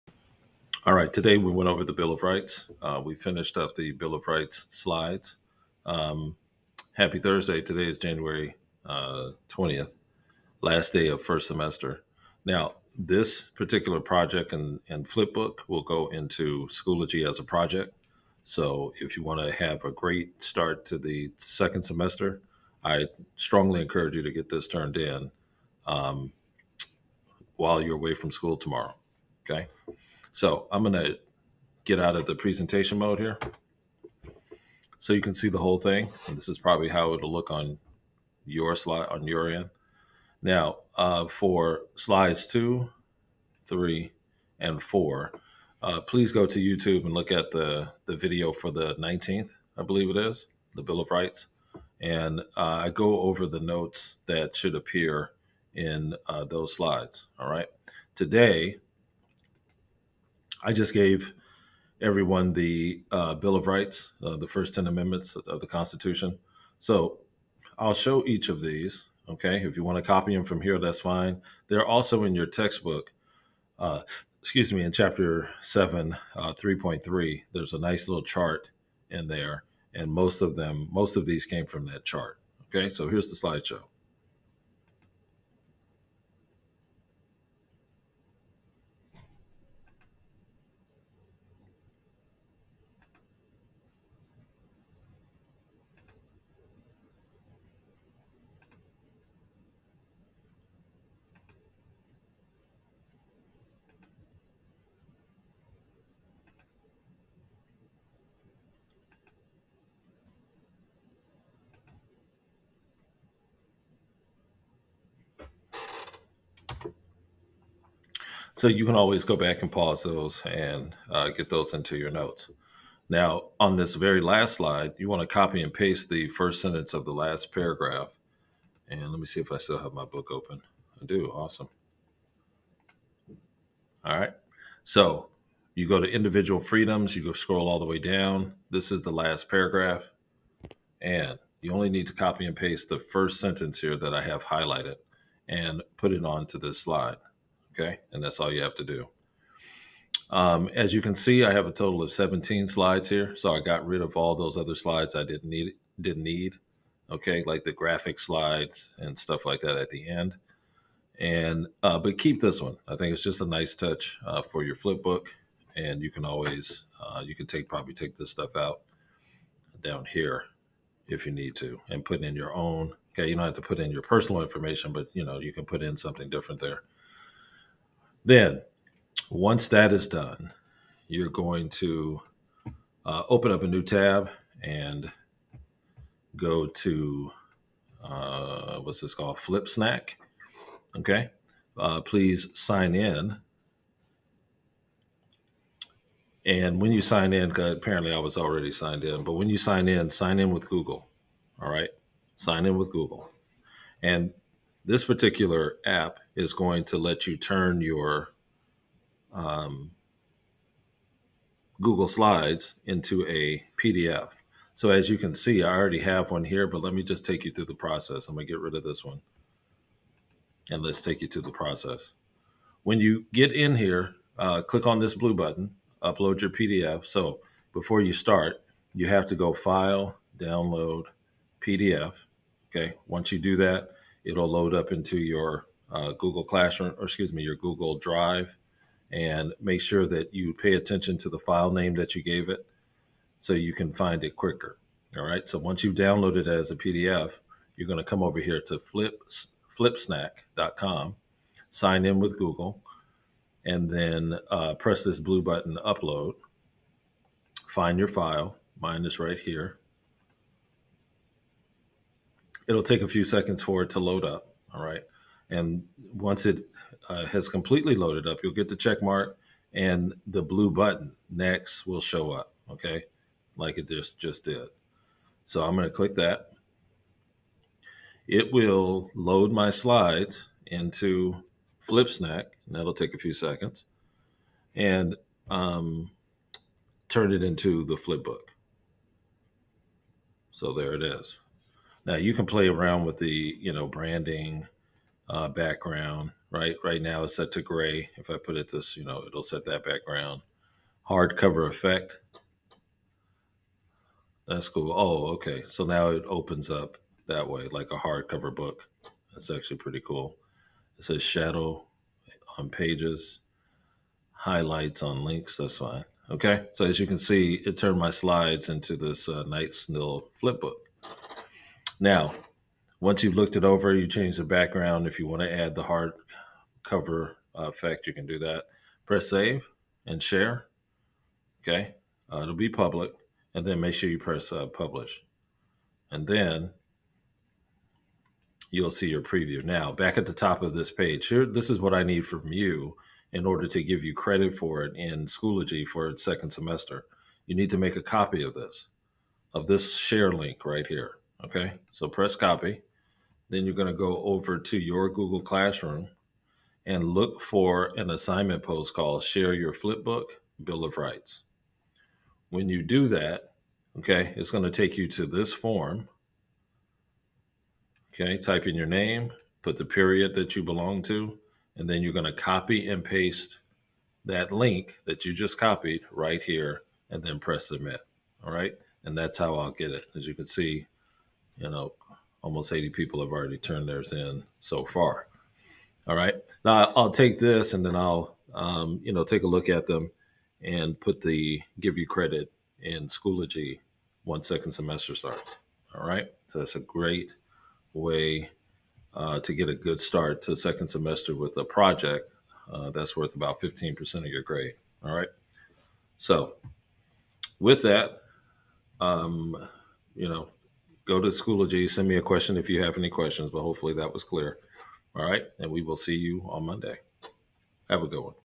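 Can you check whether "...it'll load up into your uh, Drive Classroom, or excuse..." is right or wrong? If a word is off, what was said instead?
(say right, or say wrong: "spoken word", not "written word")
wrong: "Google", not "Drive".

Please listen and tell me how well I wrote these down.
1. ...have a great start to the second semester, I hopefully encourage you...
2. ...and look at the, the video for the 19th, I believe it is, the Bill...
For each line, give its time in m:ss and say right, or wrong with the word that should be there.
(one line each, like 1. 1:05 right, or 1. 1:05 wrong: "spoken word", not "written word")
1. 0:19 wrong: "strongly", not "hopefully"
2. 0:47 right.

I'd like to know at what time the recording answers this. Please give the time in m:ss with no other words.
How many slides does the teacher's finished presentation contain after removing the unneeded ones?
2:32.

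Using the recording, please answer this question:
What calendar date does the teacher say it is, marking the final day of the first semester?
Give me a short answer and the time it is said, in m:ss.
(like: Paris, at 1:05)
January 20th, at 0:07.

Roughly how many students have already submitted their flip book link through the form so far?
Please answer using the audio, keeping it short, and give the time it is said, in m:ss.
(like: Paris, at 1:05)
80, at 6:22.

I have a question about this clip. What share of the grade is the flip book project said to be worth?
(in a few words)
15%.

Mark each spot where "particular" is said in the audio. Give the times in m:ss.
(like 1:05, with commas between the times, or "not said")
0:13, 3:25.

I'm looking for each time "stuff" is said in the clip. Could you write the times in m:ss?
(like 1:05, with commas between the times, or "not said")
2:39, 2:48.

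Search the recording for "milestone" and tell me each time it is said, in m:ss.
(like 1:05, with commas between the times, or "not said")
not said.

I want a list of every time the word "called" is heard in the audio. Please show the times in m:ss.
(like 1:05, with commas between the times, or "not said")
3:09, 5:58.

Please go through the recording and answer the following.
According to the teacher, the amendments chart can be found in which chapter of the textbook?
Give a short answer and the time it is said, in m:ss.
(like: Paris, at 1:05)
Chapter 7, at 1:14.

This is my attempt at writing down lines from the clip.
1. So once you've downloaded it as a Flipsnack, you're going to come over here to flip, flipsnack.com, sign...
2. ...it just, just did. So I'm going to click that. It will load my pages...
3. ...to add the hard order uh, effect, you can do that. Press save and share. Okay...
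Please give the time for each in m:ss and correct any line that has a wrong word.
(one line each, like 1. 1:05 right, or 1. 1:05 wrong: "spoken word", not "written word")
1. 4:05 wrong: "PDF", not "Flipsnack"
2. 4:33 wrong: "slides", not "pages"
3. 5:25 wrong: "cover", not "order".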